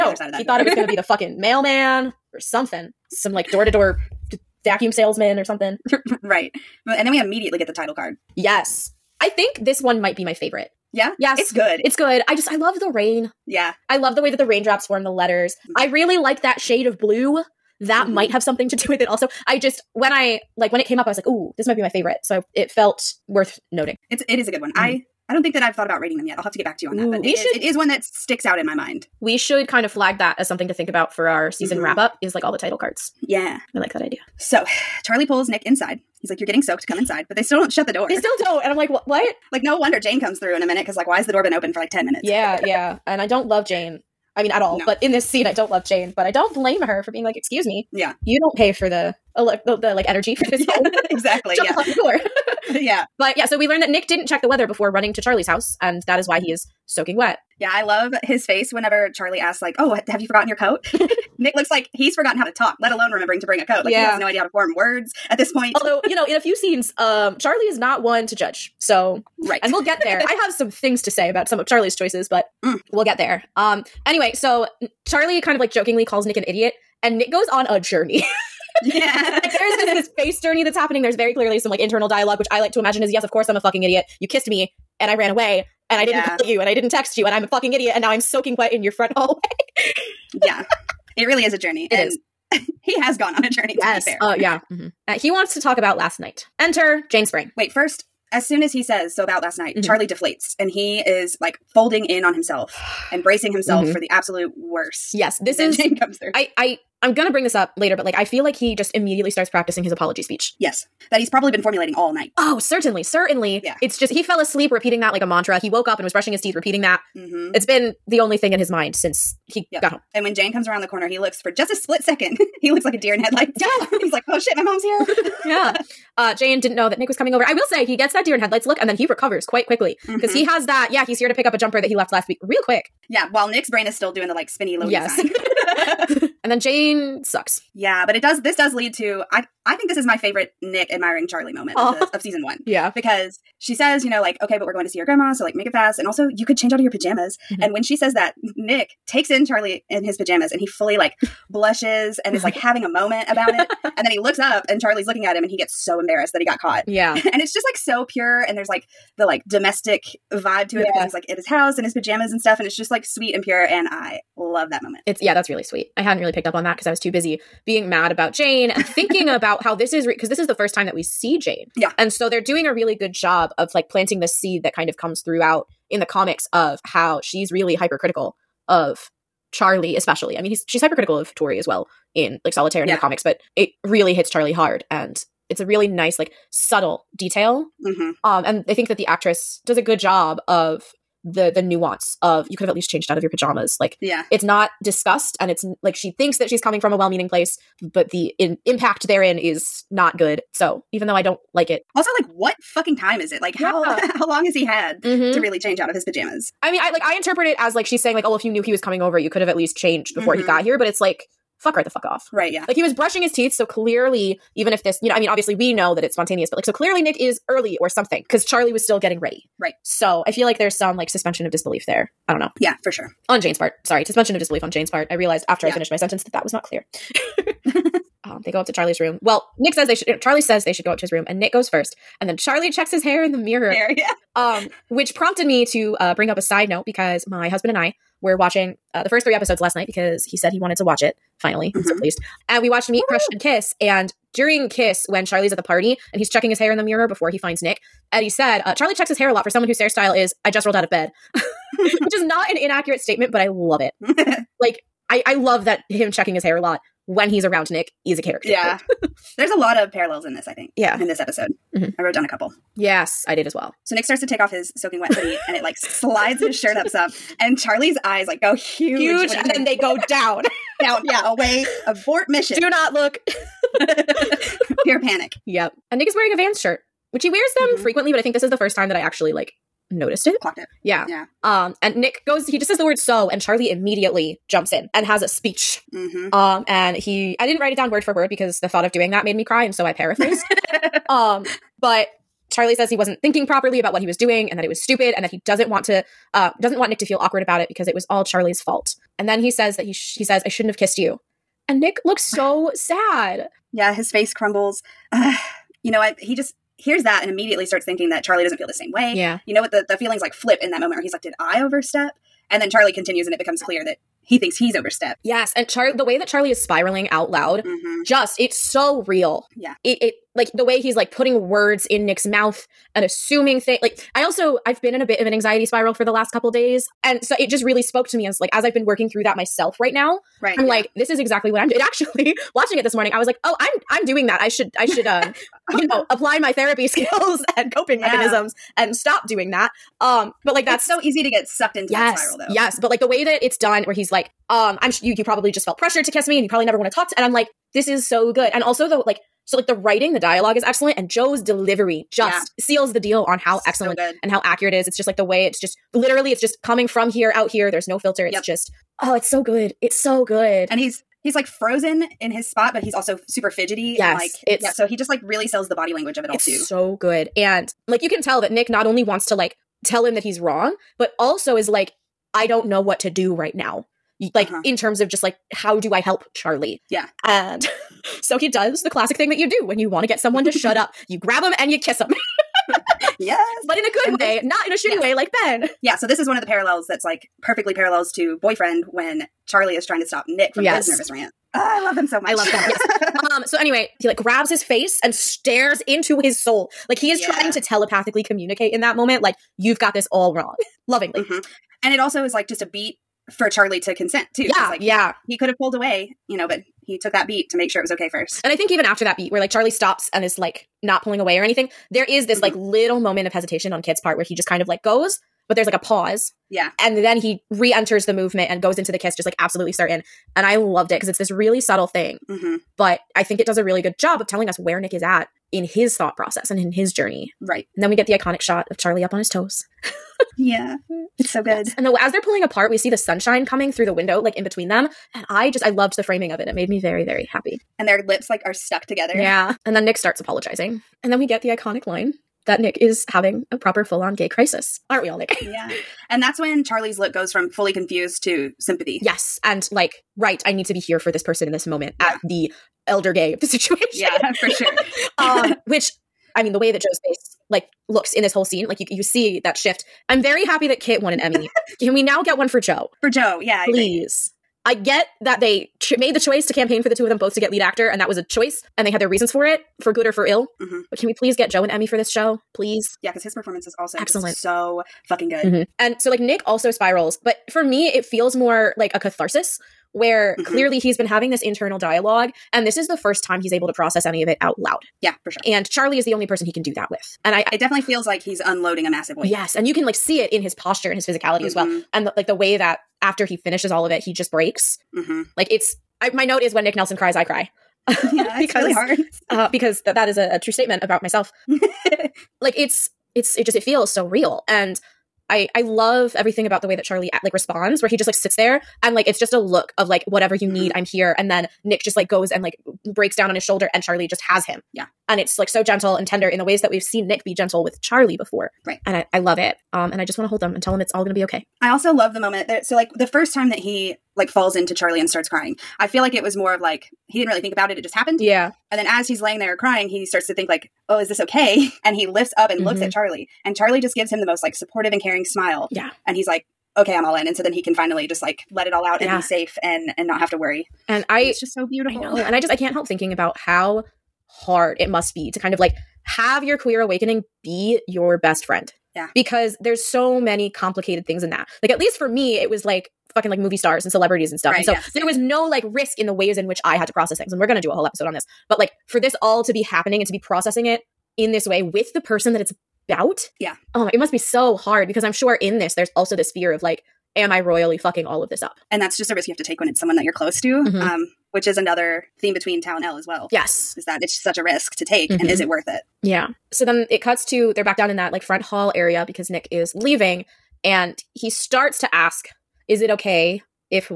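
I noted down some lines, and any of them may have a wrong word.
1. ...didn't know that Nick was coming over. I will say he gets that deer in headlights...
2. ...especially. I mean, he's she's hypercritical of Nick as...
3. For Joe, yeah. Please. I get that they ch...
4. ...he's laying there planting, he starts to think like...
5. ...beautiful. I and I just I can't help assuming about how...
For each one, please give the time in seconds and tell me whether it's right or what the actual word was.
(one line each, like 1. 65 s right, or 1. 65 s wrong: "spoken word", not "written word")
1. 126 s right
2. 179 s wrong: "Tori", not "Nick"
3. 463 s right
4. 529 s wrong: "crying", not "planting"
5. 541 s wrong: "thinking", not "assuming".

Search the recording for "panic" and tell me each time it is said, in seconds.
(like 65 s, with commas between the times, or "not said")
275 s.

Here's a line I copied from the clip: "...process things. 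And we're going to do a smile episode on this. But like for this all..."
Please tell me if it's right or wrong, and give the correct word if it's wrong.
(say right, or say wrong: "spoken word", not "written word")
wrong: "whole", not "smile".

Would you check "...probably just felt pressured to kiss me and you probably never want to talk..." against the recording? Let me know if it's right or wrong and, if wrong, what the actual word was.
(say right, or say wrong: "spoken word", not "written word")
right.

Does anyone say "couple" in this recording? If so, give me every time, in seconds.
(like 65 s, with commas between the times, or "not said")
262 s, 326 s.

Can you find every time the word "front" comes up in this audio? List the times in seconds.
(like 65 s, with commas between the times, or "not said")
88 s, 578 s.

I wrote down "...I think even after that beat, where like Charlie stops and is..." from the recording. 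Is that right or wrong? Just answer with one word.
right.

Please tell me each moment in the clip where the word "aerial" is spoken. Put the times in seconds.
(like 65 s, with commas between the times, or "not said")
not said.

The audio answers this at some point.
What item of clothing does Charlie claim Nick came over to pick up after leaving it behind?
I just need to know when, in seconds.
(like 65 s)
131 s.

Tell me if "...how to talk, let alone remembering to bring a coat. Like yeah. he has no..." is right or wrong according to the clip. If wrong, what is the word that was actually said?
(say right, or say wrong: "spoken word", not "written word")
right.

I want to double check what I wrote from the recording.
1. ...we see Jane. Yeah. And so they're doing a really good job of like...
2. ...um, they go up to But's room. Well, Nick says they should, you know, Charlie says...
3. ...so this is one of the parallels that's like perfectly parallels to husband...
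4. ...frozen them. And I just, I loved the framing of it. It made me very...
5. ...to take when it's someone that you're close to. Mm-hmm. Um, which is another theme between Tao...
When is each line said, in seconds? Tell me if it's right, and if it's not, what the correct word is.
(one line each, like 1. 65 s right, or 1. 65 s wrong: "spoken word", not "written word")
1. 170 s right
2. 228 s wrong: "Charlie", not "But"
3. 385 s wrong: "boyfriend", not "husband"
4. 434 s wrong: "between", not "frozen"
5. 569 s right.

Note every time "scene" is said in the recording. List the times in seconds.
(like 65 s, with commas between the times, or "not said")
45 s, 66 s, 458 s.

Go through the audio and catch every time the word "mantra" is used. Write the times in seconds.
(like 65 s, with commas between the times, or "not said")
115 s.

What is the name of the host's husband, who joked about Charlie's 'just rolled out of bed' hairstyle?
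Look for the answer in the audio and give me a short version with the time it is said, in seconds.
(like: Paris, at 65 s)
Eddie, at 248 s.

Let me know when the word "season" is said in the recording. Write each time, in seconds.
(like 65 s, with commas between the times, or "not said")
31 s, 142 s.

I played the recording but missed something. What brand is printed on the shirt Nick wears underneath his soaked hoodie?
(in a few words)
Vans.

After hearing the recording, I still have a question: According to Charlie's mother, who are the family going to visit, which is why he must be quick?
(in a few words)
Grandma.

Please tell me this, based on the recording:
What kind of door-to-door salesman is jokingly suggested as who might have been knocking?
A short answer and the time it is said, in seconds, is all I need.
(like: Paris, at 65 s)
Vacuum salesman, at 4 s.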